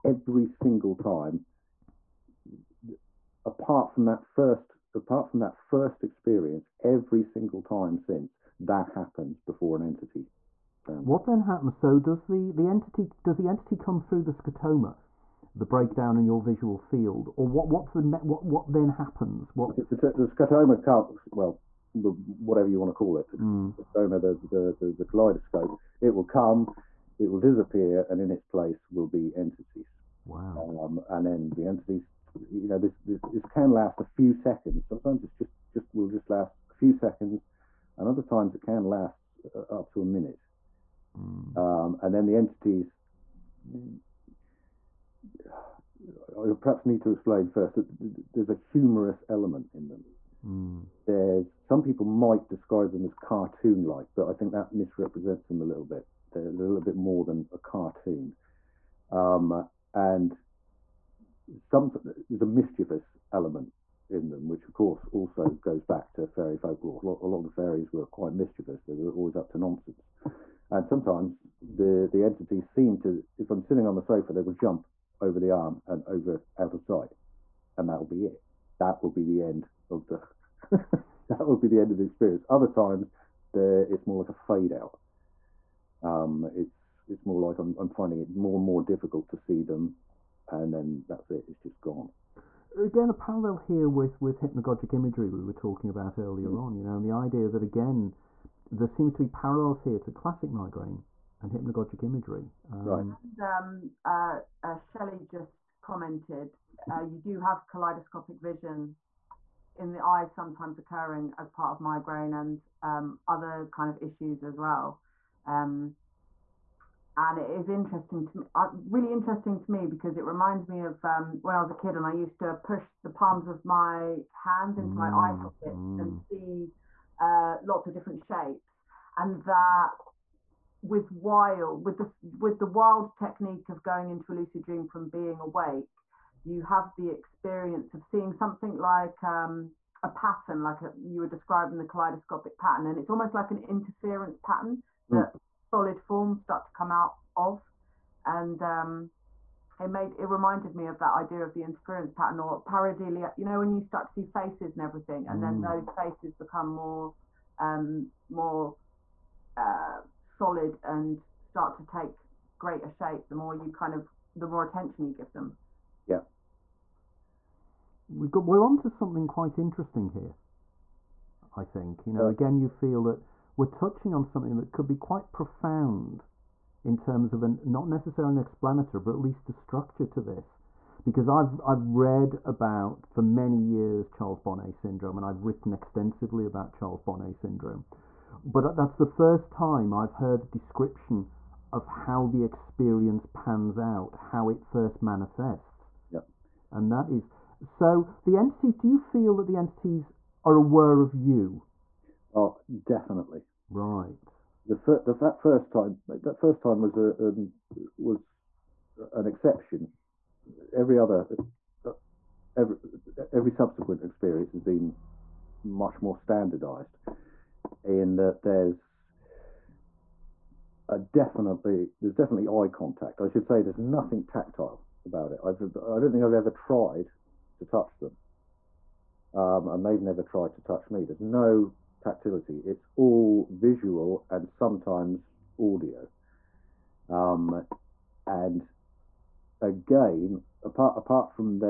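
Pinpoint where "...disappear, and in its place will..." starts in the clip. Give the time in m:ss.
0:27.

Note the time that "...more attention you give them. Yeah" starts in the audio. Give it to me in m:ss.
2:44.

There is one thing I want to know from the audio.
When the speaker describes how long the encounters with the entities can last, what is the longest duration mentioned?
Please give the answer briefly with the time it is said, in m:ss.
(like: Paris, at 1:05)
Up to a minute, at 0:39.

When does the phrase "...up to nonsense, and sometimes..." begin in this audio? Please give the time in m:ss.
1:09.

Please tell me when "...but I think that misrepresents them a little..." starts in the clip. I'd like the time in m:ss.
0:54.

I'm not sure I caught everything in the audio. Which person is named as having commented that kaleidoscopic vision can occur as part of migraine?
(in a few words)
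Shelley.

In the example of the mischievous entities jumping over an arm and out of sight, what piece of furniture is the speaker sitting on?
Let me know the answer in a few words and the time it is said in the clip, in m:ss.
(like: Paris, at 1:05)
Sofa, at 1:14.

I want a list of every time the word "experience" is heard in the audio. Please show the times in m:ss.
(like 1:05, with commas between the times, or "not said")
0:06, 1:22, 2:17, 3:12, 3:34.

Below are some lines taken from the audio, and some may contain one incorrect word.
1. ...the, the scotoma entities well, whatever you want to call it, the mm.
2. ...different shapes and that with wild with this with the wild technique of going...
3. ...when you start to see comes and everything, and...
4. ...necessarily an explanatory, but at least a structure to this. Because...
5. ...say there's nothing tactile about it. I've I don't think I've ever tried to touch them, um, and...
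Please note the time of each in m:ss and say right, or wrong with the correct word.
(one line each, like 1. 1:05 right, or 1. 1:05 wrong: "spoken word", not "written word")
1. 0:19 wrong: "comes", not "entities"
2. 2:07 right
3. 2:33 wrong: "faces", not "comes"
4. 2:57 right
5. 3:43 right.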